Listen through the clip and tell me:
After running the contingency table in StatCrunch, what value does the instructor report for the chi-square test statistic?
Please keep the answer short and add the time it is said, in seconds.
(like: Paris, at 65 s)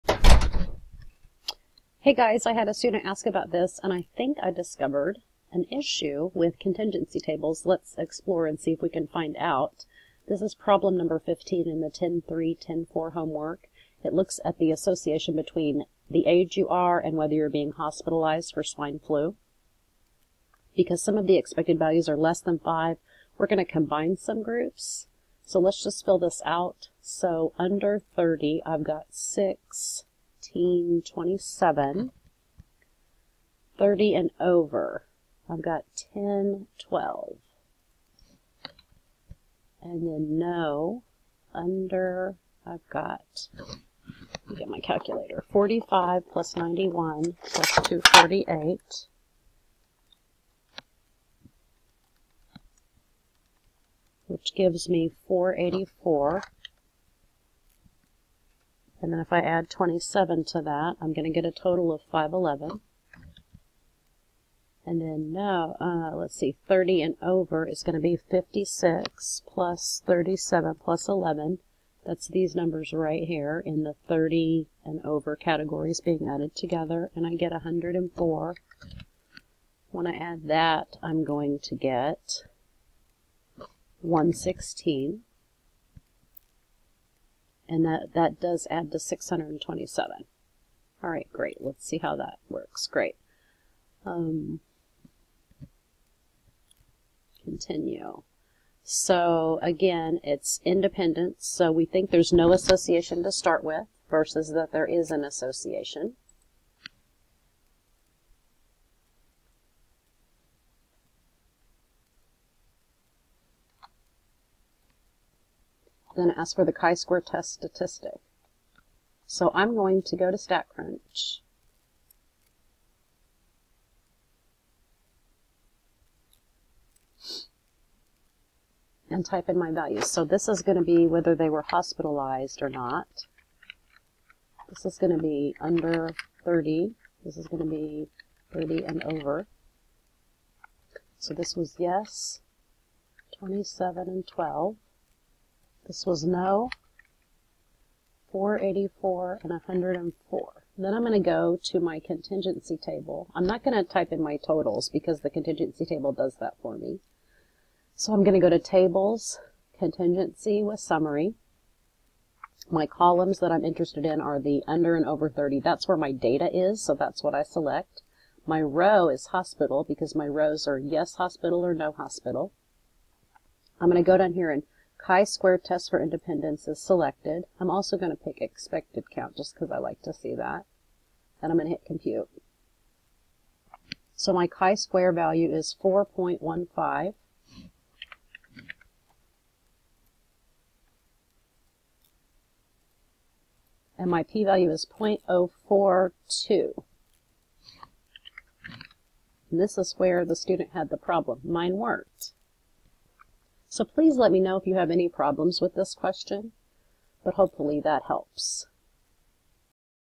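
4.15, at 185 s.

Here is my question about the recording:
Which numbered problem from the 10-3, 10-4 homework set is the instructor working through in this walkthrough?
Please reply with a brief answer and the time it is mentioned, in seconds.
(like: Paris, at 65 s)
15, at 11 s.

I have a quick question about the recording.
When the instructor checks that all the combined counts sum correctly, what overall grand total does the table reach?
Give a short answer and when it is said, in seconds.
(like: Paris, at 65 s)
627, at 88 s.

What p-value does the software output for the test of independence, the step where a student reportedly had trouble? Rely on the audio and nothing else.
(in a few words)
0.042.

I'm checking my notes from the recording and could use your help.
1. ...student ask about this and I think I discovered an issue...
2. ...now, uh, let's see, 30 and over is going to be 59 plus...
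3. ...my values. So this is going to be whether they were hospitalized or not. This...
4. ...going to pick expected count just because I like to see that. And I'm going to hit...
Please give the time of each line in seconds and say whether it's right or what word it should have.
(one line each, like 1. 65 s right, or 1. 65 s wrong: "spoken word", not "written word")
1. 2 s right
2. 65 s wrong: "56", not "59"
3. 129 s right
4. 177 s right.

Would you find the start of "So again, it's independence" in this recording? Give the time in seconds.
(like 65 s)
98 s.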